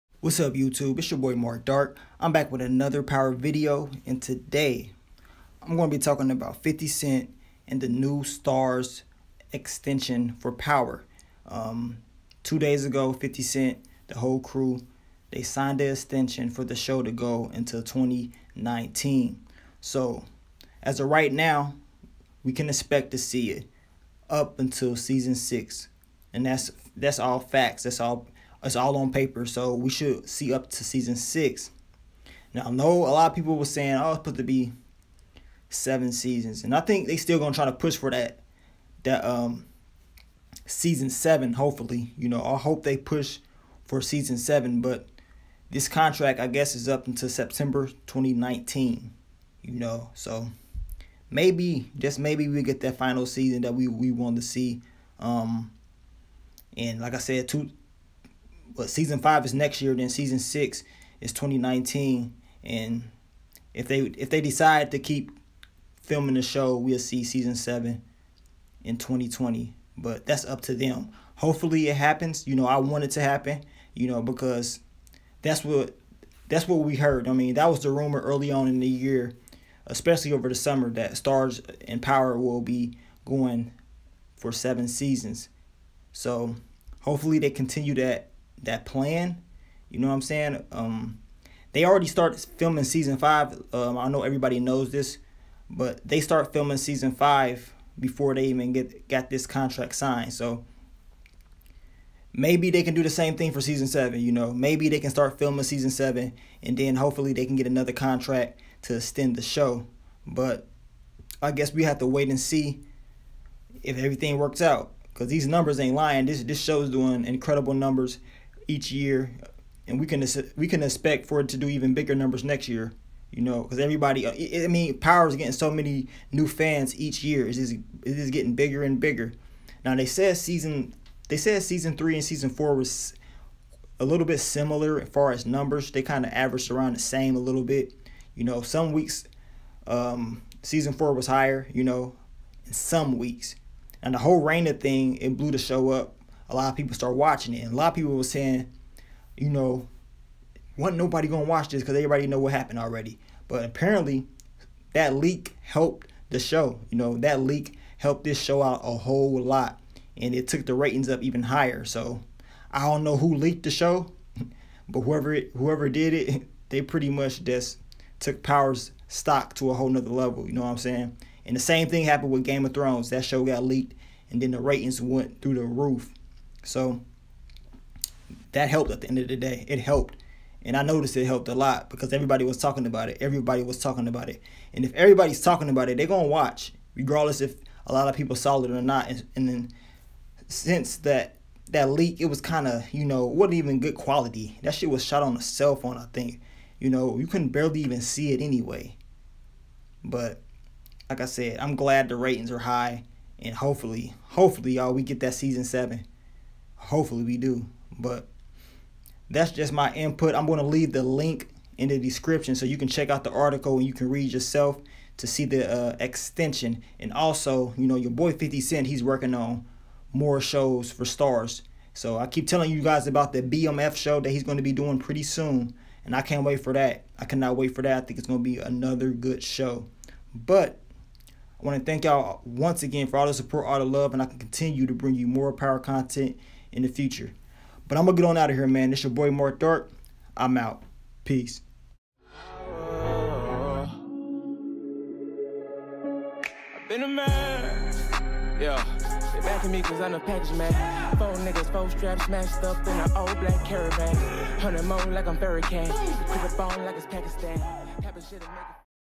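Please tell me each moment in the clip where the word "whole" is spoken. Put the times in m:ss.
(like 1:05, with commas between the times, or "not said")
0:14, 2:24, 2:38, 2:49.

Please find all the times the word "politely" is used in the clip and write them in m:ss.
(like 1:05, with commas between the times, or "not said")
not said.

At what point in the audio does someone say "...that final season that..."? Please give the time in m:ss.
0:52.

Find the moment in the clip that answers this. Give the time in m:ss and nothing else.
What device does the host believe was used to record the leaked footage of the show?
3:15.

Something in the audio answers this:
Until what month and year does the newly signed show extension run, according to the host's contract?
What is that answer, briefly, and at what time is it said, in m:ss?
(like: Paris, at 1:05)
September 2019, at 0:47.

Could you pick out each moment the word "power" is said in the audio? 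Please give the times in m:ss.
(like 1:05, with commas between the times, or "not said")
0:03, 0:10, 1:22, 2:04, 2:48, 3:55.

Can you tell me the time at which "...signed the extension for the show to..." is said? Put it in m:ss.
0:15.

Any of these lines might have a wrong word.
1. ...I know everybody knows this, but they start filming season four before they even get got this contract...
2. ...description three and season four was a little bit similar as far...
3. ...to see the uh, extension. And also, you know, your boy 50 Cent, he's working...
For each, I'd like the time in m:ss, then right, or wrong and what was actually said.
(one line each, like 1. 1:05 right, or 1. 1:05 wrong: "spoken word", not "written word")
1. 1:33 wrong: "five", not "four"
2. 2:11 wrong: "season", not "description"
3. 3:35 right.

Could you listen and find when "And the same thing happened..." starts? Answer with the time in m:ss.
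2:51.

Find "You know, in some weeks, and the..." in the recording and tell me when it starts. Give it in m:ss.
2:21.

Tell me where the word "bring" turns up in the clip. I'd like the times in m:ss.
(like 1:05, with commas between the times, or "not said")
3:54.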